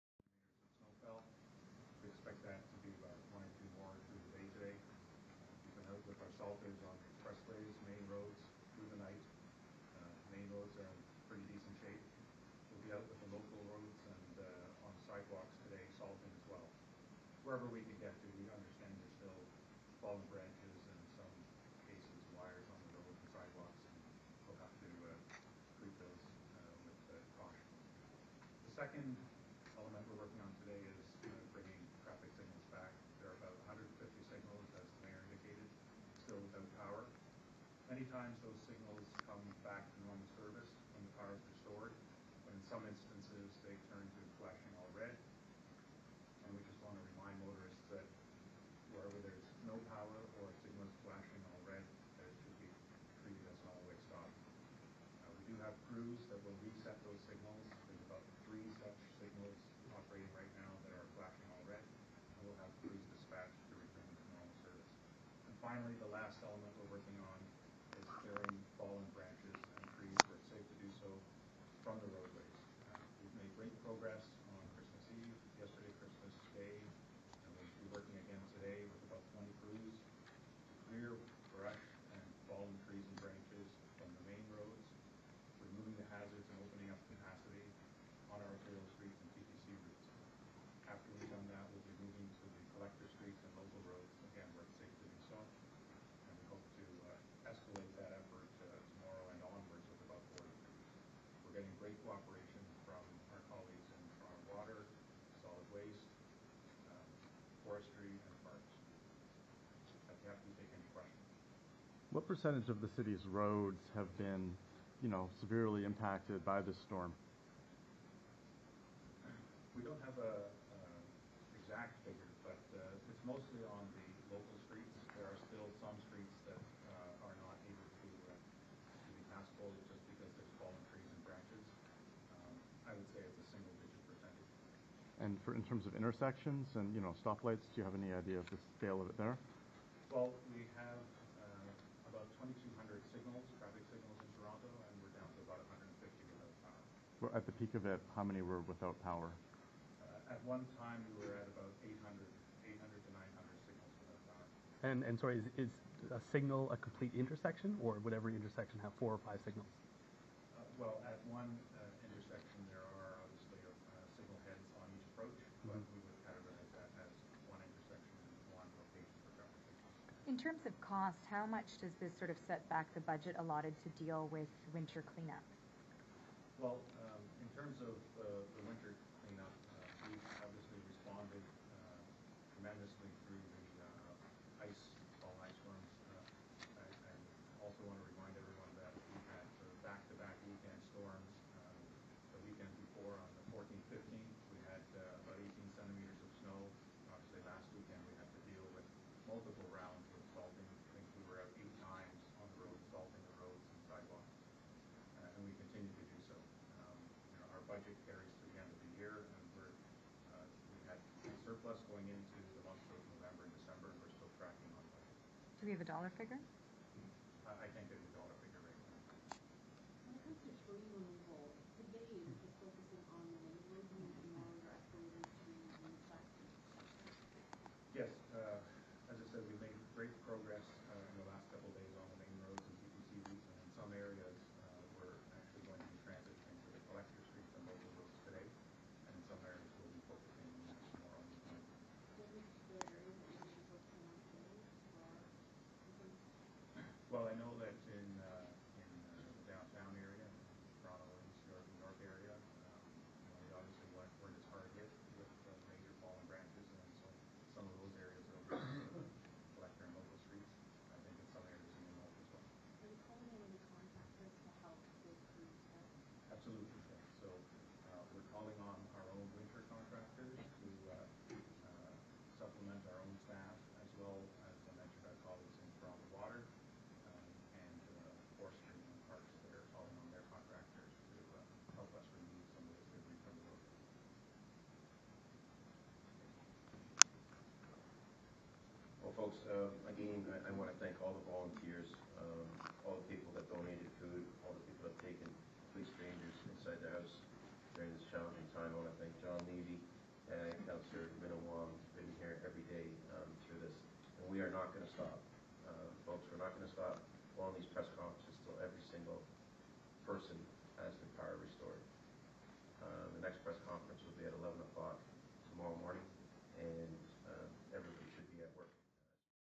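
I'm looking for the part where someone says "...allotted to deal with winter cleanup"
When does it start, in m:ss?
2:53.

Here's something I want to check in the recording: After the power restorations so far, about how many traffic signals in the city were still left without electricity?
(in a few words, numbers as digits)
150.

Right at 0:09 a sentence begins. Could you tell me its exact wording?
Uh, main roads are in pretty decent shape.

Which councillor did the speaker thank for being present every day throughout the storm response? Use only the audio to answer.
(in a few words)
Minnan-Wong.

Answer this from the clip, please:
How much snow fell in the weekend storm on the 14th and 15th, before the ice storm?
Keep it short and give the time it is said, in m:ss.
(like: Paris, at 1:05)
18 centimeters, at 3:15.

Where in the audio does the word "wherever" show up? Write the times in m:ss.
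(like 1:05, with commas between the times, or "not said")
0:17, 0:48.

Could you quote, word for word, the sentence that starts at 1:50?
I'd be happy to take any questions.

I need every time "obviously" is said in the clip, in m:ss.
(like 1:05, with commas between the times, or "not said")
3:00, 3:17.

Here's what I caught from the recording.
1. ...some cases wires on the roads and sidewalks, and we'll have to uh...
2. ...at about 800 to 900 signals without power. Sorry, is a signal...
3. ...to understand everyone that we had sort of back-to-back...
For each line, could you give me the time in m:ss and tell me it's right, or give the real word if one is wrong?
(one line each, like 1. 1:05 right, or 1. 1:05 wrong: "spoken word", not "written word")
1. 0:21 right
2. 2:31 right
3. 3:07 wrong: "remind", not "understand".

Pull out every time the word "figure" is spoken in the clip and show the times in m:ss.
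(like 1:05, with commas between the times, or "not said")
2:02, 3:36.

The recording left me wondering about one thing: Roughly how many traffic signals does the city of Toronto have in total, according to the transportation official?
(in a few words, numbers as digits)
2,200.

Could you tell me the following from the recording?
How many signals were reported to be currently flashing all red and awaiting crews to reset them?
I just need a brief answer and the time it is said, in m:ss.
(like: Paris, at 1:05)
3, at 0:58.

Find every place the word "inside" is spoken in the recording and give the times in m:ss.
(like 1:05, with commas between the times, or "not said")
4:56.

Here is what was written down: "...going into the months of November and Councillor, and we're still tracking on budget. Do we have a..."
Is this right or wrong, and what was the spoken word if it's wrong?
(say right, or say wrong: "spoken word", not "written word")
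wrong: "December", not "Councillor".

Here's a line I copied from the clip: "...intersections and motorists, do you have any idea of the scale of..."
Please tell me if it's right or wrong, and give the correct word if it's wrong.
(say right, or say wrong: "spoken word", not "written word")
wrong: "stoplights", not "motorists".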